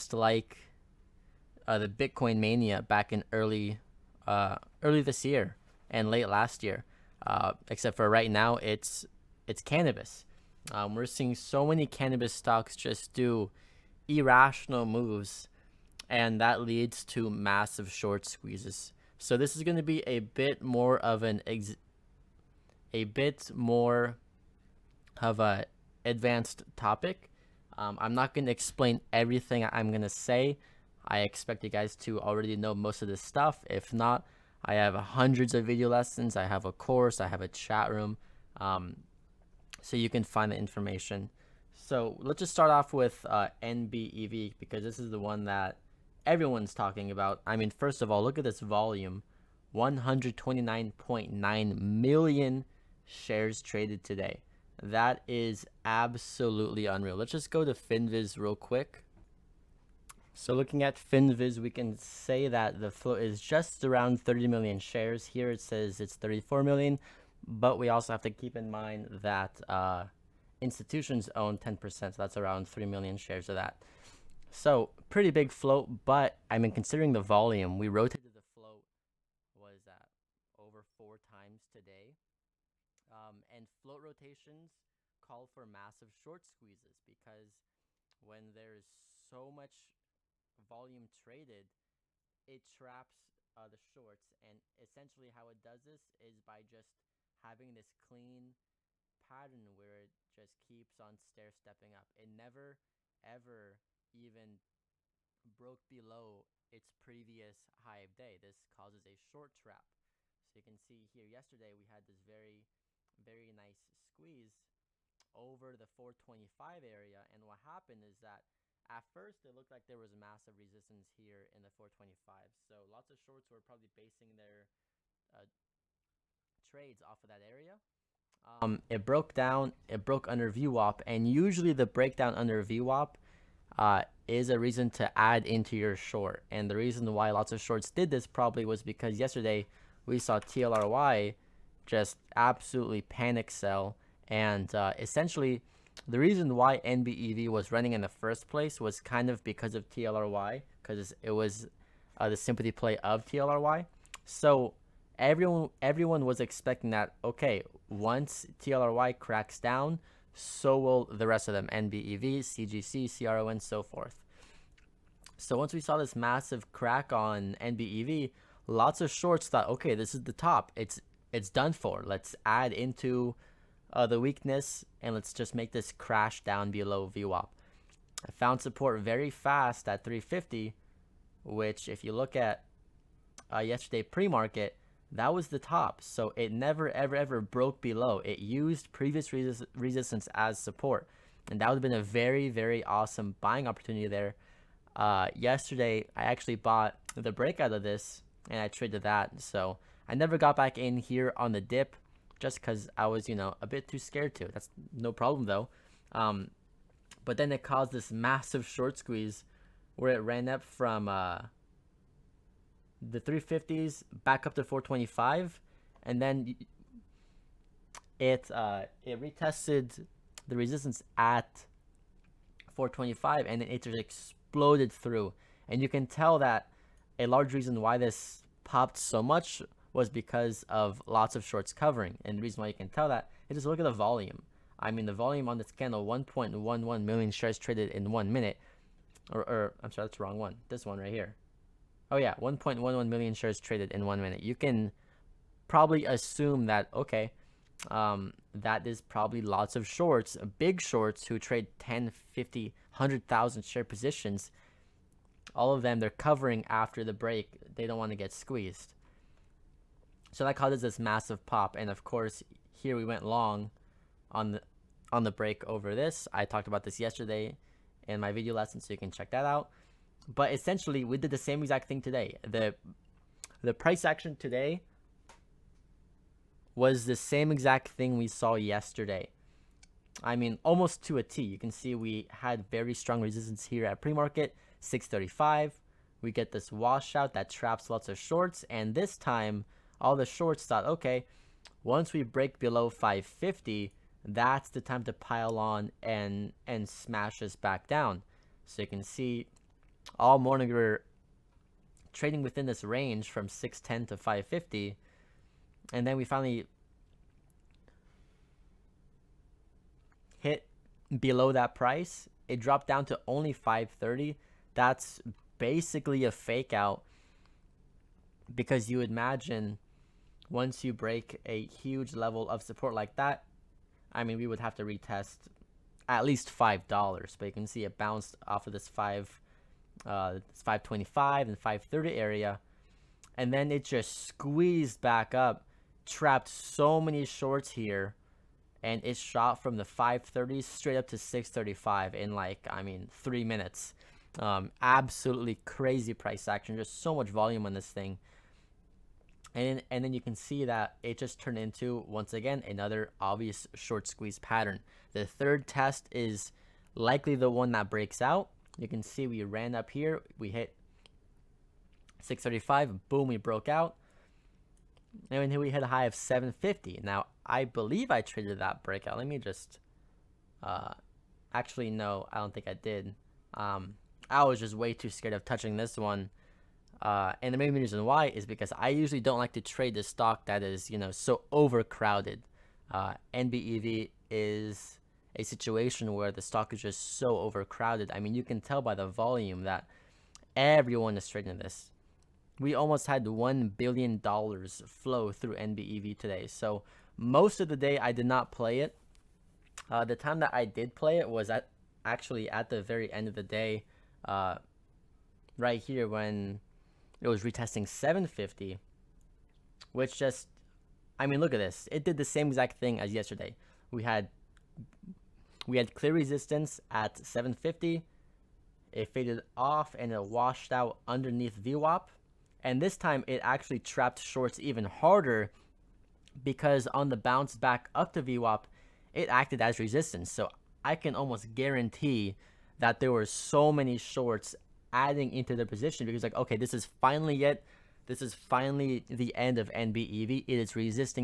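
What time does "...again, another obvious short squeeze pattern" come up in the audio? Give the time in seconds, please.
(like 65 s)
352 s.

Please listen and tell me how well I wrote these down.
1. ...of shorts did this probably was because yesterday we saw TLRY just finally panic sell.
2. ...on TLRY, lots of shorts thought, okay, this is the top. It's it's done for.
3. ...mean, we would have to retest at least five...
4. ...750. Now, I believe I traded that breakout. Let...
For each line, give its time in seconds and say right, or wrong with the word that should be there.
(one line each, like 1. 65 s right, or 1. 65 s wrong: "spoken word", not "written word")
1. 137 s wrong: "absolutely", not "finally"
2. 167 s wrong: "NBEV", not "TLRY"
3. 324 s right
4. 366 s right.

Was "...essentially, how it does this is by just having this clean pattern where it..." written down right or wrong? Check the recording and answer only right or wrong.
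right.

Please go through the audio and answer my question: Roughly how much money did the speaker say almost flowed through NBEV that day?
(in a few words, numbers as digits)
$1 billion.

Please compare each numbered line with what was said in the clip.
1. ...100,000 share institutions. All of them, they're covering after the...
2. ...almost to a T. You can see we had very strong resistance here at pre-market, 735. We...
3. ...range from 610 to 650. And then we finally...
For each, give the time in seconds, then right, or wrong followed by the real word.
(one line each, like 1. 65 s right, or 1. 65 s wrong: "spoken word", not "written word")
1. 252 s wrong: "positions", not "institutions"
2. 280 s wrong: "635", not "735"
3. 302 s wrong: "550", not "650".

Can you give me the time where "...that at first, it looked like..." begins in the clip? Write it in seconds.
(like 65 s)
118 s.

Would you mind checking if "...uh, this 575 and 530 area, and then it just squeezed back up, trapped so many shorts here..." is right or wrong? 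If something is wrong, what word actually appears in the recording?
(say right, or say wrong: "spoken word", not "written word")
wrong: "525", not "575".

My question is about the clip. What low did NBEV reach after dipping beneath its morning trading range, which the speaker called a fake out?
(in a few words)
530.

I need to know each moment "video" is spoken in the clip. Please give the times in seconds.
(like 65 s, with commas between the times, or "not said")
35 s, 268 s.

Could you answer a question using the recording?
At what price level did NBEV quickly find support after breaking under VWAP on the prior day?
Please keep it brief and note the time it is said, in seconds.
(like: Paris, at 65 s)
350, at 180 s.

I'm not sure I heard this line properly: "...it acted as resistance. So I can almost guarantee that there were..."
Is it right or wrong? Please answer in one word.
right.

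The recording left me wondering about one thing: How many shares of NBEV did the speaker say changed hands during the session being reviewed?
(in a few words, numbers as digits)
129.9 million.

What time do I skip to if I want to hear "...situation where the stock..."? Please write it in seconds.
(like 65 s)
385 s.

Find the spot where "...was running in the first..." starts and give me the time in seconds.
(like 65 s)
147 s.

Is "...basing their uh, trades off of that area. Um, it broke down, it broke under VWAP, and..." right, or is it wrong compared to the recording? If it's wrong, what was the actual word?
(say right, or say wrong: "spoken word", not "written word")
right.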